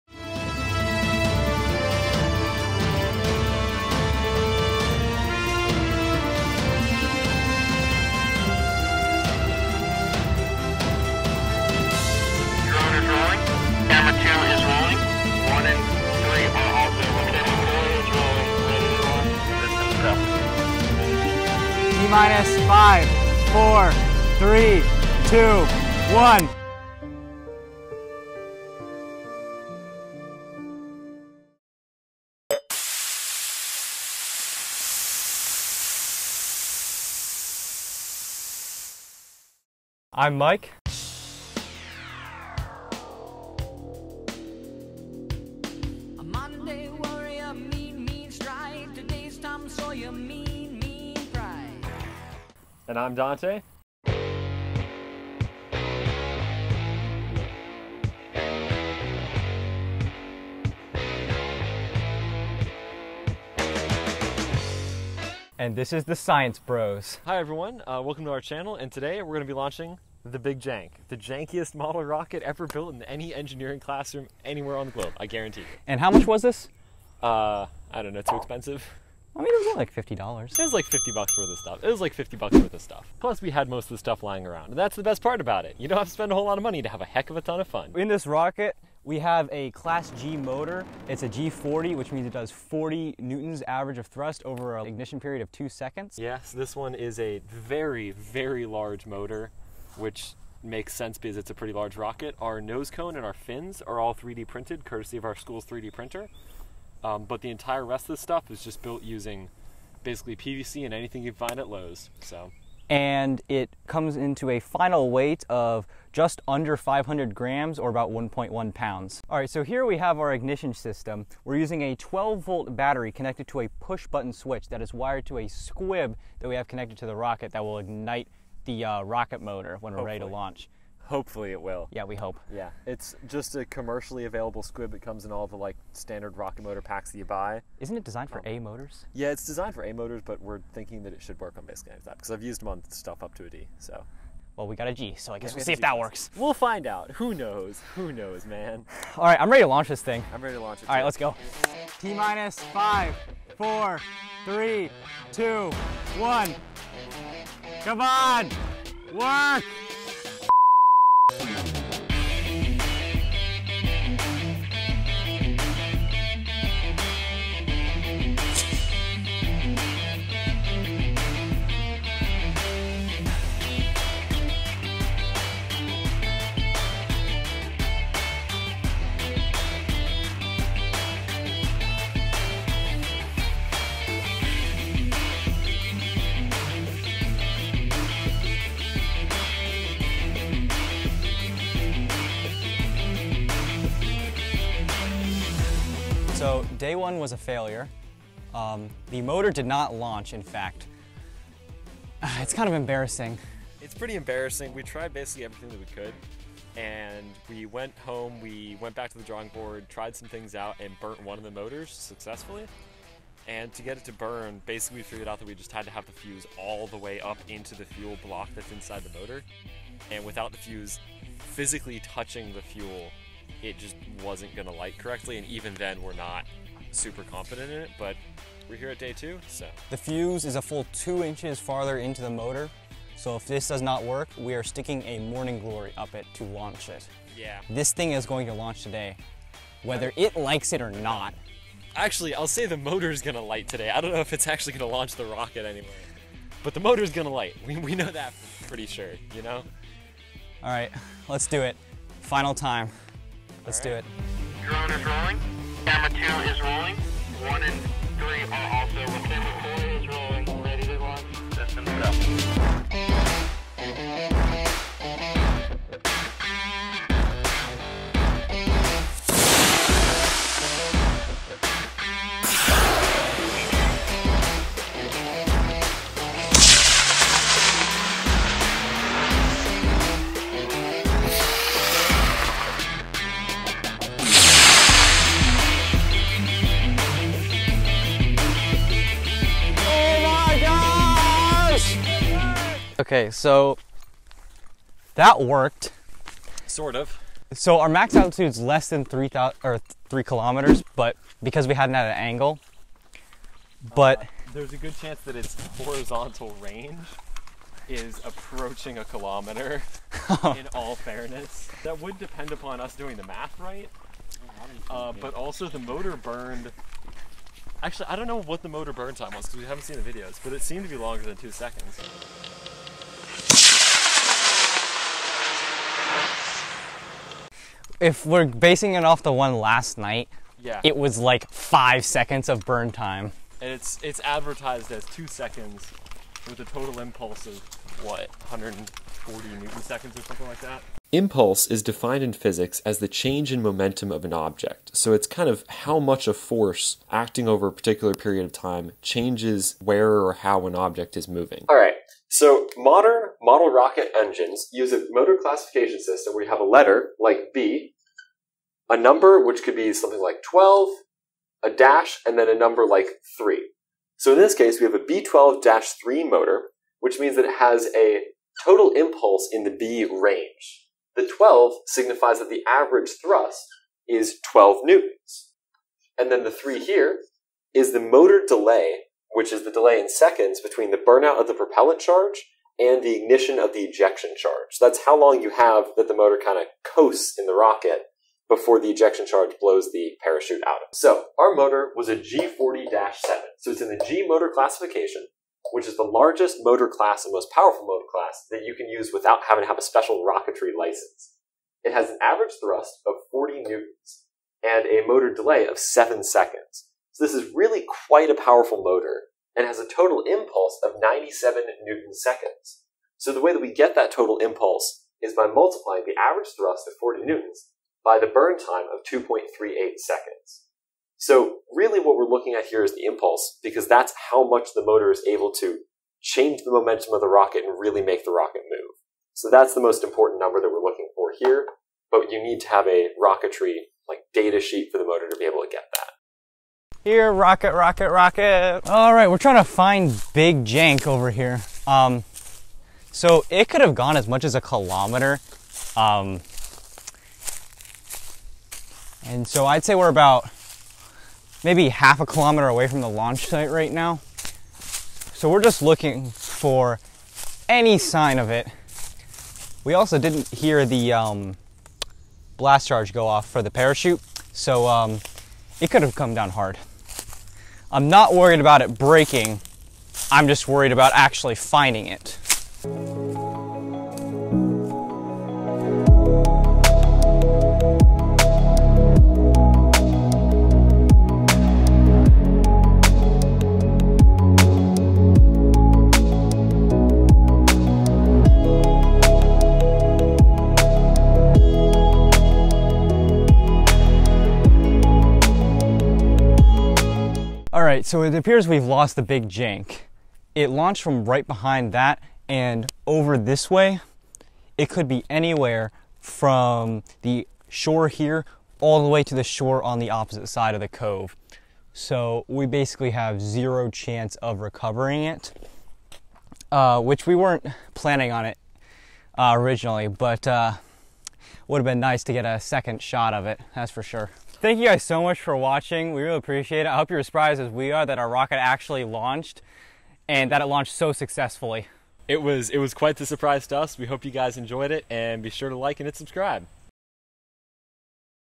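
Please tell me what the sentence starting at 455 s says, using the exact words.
So we're just looking for any sign of it.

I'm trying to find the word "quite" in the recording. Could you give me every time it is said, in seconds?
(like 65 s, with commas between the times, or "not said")
408 s, 532 s.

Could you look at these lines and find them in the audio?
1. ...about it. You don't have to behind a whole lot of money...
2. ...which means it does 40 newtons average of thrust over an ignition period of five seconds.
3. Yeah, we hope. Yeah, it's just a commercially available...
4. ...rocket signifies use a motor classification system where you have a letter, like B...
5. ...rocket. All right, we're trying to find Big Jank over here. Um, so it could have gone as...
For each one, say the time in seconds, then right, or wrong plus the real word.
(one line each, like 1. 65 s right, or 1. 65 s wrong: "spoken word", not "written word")
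1. 85 s wrong: "spend", not "behind"
2. 91 s wrong: "two", not "five"
3. 131 s right
4. 353 s wrong: "engines", not "signifies"
5. 438 s right.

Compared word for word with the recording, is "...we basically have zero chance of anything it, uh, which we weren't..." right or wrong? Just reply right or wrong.
wrong.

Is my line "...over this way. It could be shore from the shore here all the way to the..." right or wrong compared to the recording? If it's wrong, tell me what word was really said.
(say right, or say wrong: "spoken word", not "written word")
wrong: "anywhere", not "shore".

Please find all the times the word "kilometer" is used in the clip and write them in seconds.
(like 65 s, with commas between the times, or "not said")
300 s, 309 s, 444 s, 452 s.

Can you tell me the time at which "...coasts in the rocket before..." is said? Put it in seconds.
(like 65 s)
386 s.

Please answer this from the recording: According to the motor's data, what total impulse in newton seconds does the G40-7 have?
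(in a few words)
97 newton seconds.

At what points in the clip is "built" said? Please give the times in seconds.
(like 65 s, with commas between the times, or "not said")
72 s, 108 s.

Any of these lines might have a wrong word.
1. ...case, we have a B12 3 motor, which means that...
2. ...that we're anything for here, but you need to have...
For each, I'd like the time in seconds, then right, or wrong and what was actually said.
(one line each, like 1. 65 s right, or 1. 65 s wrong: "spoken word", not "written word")
1. 364 s right
2. 430 s wrong: "looking", not "anything".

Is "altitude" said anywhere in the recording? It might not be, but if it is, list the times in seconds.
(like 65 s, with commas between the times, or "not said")
298 s.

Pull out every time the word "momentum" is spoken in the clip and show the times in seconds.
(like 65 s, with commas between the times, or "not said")
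343 s, 426 s.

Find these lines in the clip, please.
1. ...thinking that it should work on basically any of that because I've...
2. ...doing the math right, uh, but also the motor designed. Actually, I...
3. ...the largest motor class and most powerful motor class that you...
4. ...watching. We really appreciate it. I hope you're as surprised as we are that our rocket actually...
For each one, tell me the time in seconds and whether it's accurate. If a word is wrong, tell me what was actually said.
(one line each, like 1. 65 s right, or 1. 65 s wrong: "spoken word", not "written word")
1. 140 s right
2. 312 s wrong: "burned", not "designed"
3. 395 s right
4. 525 s right.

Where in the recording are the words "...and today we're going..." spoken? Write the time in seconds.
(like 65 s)
68 s.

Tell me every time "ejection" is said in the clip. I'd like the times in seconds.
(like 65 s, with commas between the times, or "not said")
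383 s, 388 s.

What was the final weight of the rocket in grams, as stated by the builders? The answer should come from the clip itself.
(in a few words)
just under 500 grams.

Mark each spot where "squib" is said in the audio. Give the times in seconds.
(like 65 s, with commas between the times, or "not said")
125 s, 134 s.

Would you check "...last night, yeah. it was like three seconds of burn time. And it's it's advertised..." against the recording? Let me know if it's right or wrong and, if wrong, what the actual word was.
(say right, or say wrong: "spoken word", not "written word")
wrong: "five", not "three".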